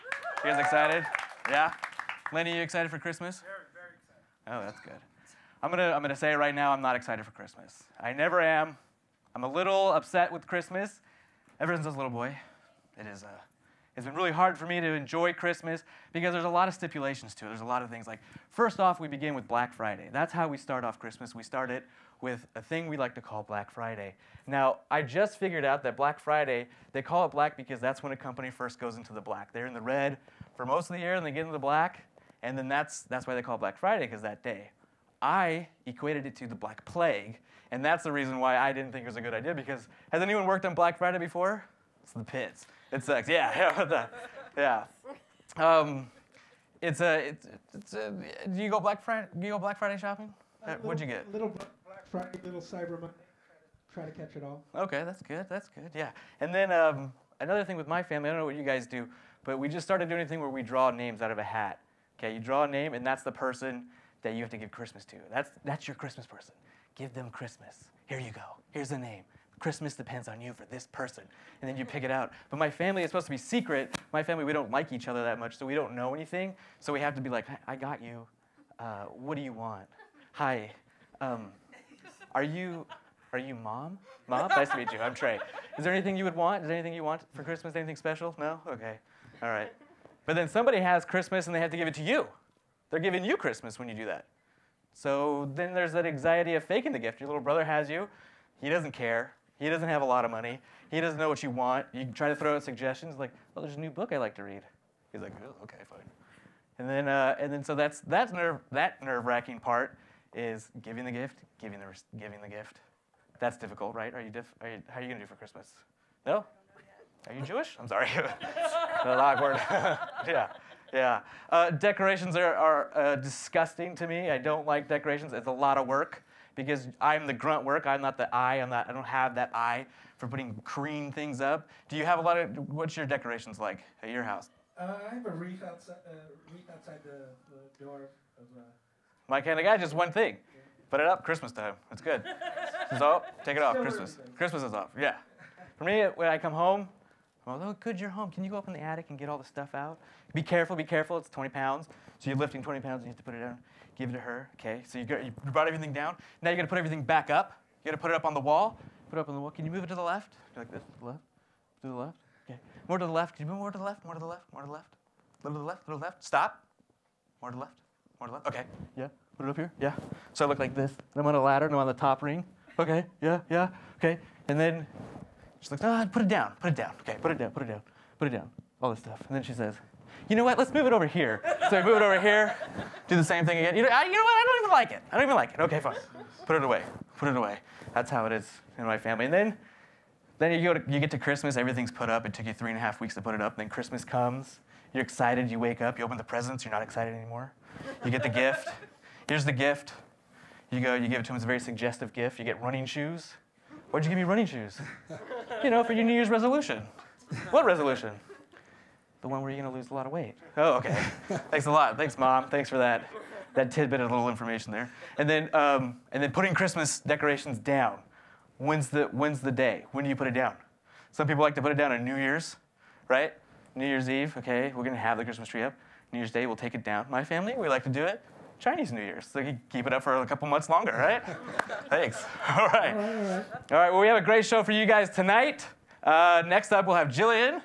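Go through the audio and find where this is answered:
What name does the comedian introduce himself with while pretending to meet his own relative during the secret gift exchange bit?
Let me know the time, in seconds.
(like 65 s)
84 s.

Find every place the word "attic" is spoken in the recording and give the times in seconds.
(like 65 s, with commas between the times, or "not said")
148 s.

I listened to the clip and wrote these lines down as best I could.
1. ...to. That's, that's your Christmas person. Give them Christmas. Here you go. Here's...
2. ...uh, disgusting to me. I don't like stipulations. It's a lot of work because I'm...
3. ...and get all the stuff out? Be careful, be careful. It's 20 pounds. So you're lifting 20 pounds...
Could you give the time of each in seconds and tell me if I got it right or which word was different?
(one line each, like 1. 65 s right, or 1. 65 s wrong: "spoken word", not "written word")
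1. 65 s right
2. 122 s wrong: "decorations", not "stipulations"
3. 149 s right.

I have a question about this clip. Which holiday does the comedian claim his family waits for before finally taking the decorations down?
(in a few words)
Chinese New Year.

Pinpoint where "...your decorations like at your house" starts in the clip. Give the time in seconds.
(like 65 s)
132 s.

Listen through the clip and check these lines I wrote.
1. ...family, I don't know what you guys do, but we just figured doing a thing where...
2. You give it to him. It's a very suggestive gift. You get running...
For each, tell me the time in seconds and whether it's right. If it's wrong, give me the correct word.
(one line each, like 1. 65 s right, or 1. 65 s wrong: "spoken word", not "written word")
1. 58 s wrong: "started", not "figured"
2. 200 s right.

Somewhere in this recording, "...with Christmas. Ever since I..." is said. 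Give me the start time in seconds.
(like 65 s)
10 s.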